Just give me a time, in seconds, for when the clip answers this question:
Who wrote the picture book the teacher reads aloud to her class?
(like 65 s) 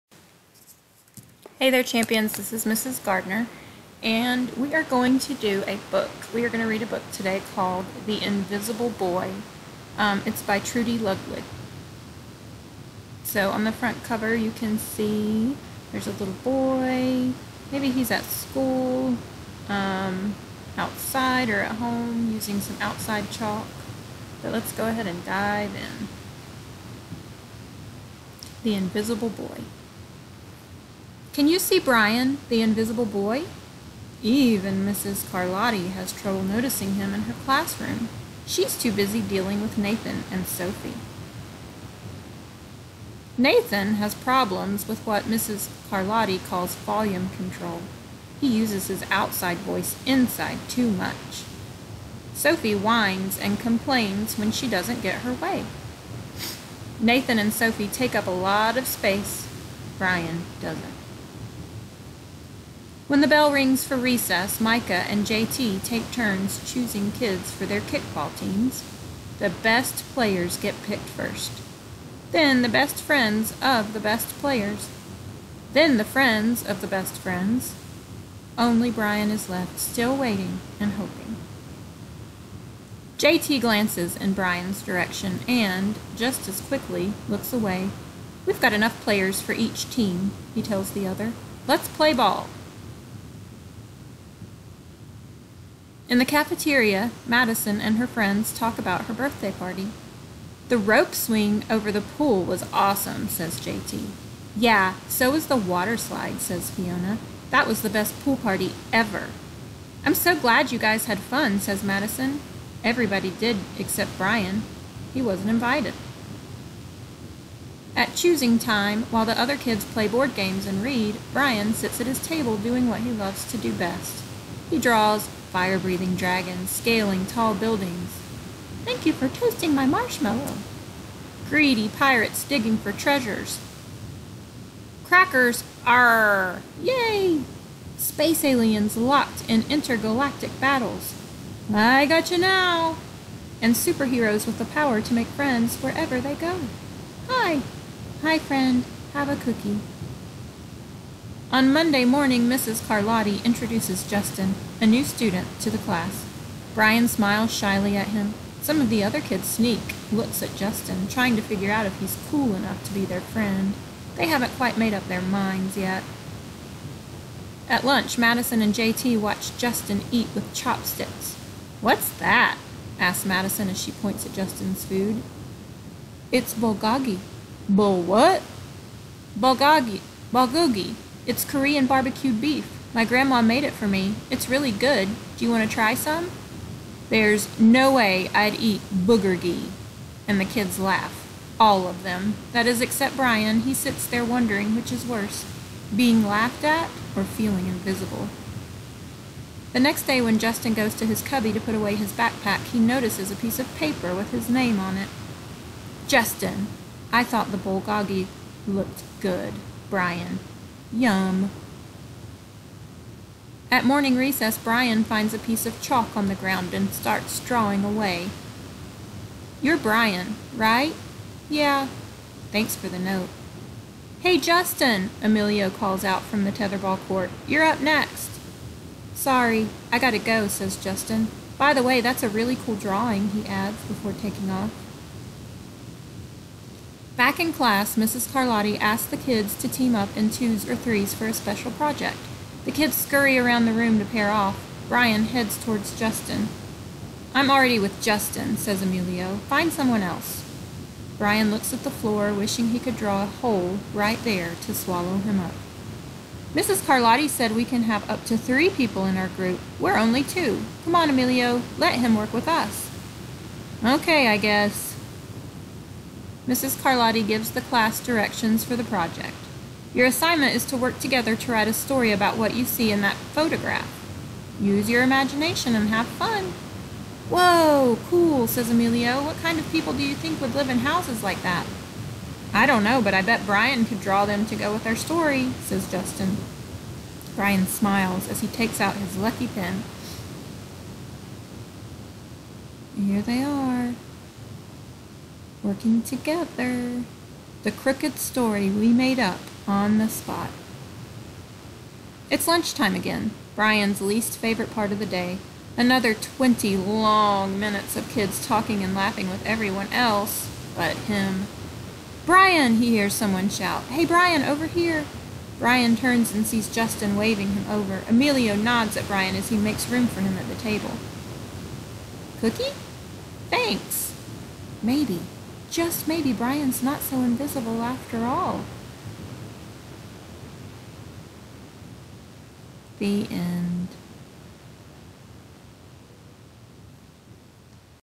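10 s.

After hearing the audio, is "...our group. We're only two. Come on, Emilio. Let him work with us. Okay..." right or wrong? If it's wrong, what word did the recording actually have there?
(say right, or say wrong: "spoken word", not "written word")
right.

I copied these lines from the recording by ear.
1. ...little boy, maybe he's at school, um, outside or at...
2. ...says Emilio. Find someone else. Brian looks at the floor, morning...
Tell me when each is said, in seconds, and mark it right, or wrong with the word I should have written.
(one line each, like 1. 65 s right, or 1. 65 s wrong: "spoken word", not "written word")
1. 16 s right
2. 248 s wrong: "wishing", not "morning".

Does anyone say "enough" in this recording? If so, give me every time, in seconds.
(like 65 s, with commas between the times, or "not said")
88 s, 162 s.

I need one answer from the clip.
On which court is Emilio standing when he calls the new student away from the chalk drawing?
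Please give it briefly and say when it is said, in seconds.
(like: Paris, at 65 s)
tetherball court, at 226 s.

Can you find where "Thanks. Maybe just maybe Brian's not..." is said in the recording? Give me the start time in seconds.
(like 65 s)
323 s.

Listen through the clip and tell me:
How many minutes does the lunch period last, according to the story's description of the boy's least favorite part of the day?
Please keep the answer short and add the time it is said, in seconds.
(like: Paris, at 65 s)
20, at 306 s.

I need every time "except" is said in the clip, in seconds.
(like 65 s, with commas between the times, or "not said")
113 s, 192 s.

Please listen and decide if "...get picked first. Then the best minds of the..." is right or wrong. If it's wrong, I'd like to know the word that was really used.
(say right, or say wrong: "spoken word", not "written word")
wrong: "friends", not "minds".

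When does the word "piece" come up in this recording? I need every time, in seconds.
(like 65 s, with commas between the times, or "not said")
203 s, 215 s.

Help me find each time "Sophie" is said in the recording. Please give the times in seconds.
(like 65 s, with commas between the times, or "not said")
40 s, 52 s, 57 s.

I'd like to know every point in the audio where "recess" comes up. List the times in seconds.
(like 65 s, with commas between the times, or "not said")
63 s, 214 s.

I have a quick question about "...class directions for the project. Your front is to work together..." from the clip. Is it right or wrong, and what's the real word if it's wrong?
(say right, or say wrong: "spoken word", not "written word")
wrong: "assignment", not "front".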